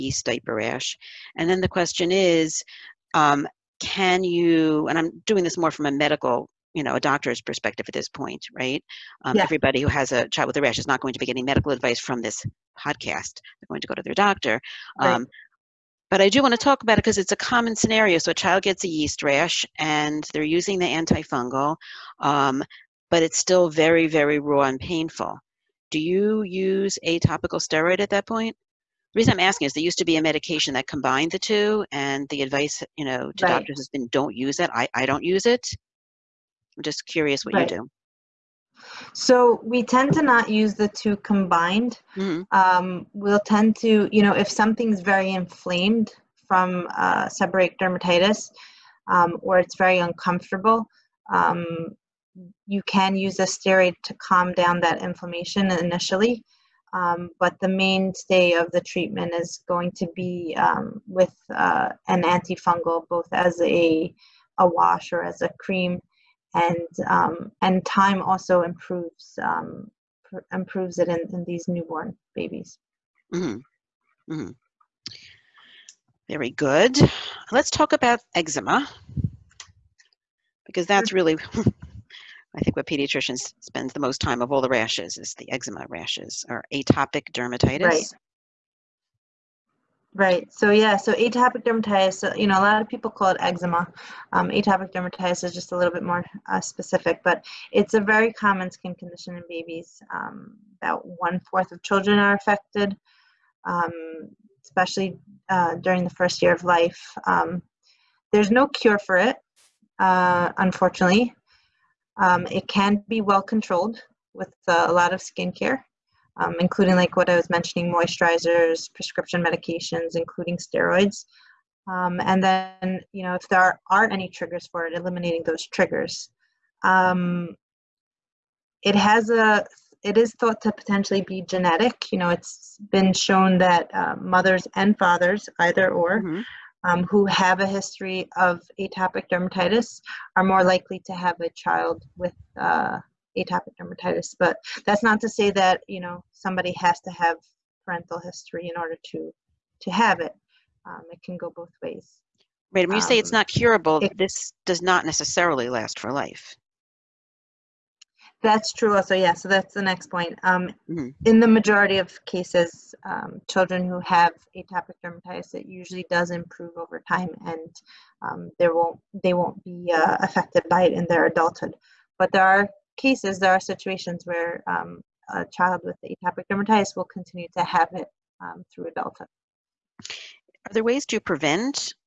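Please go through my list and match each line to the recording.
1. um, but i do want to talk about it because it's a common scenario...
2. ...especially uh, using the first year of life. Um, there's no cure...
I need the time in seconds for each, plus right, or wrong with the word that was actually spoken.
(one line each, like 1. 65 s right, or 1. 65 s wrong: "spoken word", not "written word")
1. 15 s right
2. 104 s wrong: "during", not "using".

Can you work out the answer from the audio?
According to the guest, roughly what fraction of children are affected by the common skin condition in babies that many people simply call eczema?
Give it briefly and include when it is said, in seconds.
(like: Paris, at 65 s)
1/4, at 101 s.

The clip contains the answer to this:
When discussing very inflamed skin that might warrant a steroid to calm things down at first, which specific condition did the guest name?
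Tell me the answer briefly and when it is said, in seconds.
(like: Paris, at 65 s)
seborrheic dermatitis, at 47 s.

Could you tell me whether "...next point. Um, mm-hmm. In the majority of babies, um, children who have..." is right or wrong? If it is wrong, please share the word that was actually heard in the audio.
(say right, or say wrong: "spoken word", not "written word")
wrong: "cases", not "babies".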